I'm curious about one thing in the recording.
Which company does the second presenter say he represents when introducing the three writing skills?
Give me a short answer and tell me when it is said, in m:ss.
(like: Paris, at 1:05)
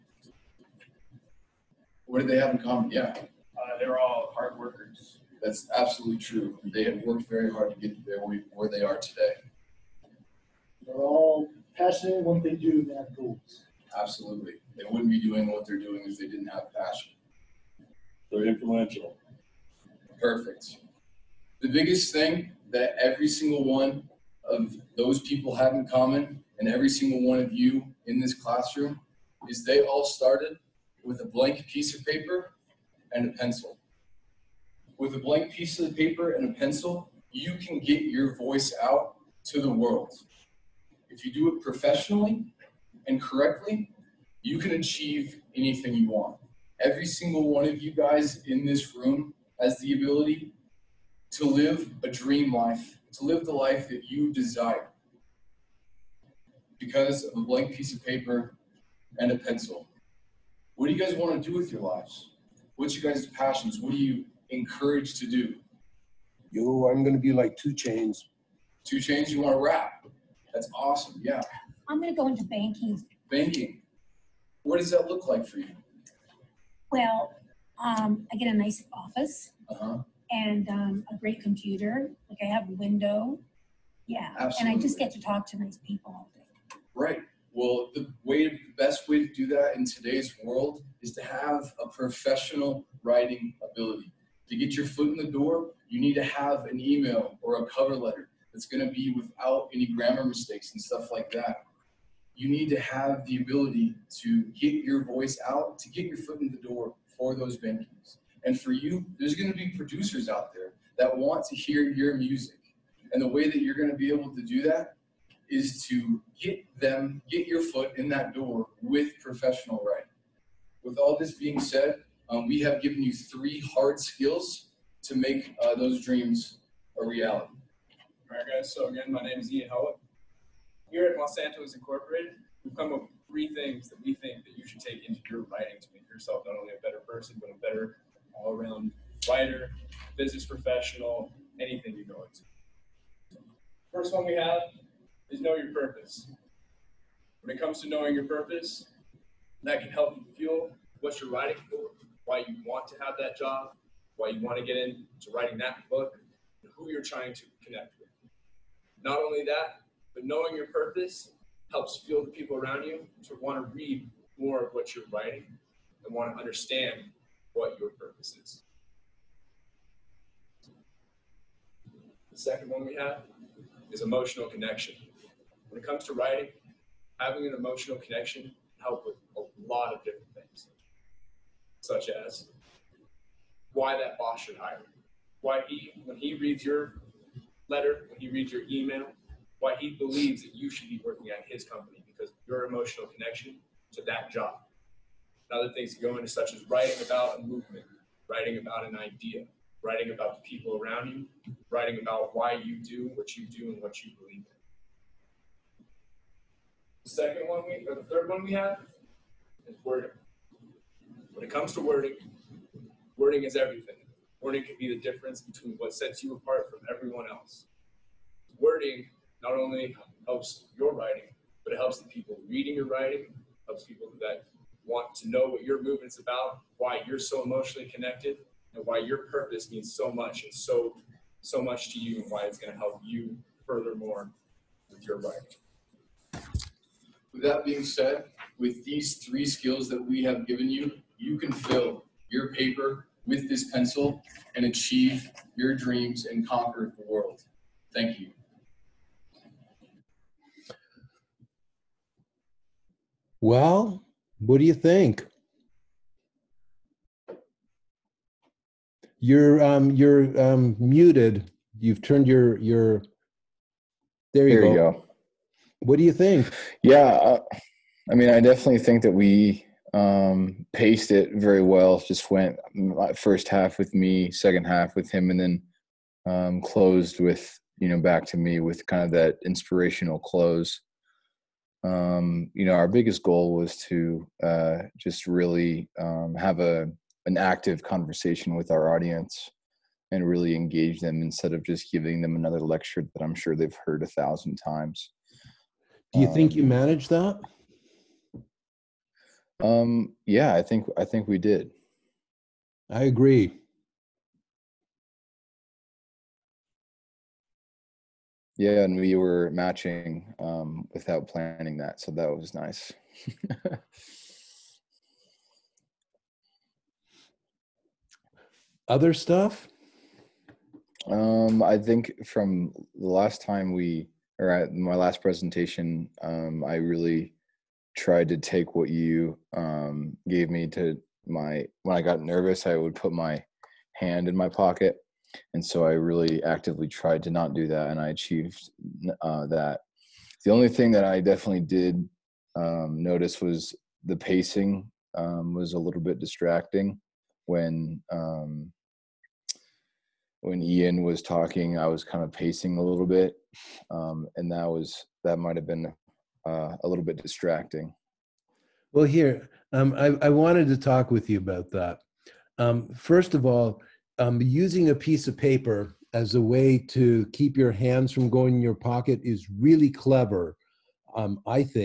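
Monsanto's Incorporated, at 2:11.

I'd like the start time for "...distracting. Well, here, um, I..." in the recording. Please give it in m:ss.
5:57.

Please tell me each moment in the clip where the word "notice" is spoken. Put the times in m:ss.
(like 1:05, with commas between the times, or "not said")
5:43.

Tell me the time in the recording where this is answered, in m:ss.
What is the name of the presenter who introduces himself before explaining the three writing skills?
2:09.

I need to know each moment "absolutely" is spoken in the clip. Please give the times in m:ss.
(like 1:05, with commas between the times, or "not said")
0:05, 0:13, 1:24.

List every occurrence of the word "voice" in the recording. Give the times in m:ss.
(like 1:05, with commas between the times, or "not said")
0:38, 1:45.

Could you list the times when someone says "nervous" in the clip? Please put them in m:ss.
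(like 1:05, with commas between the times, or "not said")
5:32.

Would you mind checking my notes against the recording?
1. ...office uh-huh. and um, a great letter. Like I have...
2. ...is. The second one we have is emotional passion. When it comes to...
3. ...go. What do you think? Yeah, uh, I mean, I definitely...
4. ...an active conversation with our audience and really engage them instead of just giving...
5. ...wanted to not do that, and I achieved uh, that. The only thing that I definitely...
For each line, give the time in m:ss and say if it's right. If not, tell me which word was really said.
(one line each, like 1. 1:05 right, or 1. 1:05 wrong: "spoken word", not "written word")
1. 1:18 wrong: "computer", not "letter"
2. 2:48 wrong: "connection", not "passion"
3. 4:24 right
4. 4:47 right
5. 5:36 wrong: "tried", not "wanted".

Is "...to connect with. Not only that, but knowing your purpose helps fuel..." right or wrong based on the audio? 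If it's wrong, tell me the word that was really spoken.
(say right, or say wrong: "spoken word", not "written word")
right.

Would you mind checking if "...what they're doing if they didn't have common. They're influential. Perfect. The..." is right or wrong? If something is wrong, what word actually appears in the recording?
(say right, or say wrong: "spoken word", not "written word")
wrong: "passion", not "common".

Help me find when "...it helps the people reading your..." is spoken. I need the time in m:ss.
3:41.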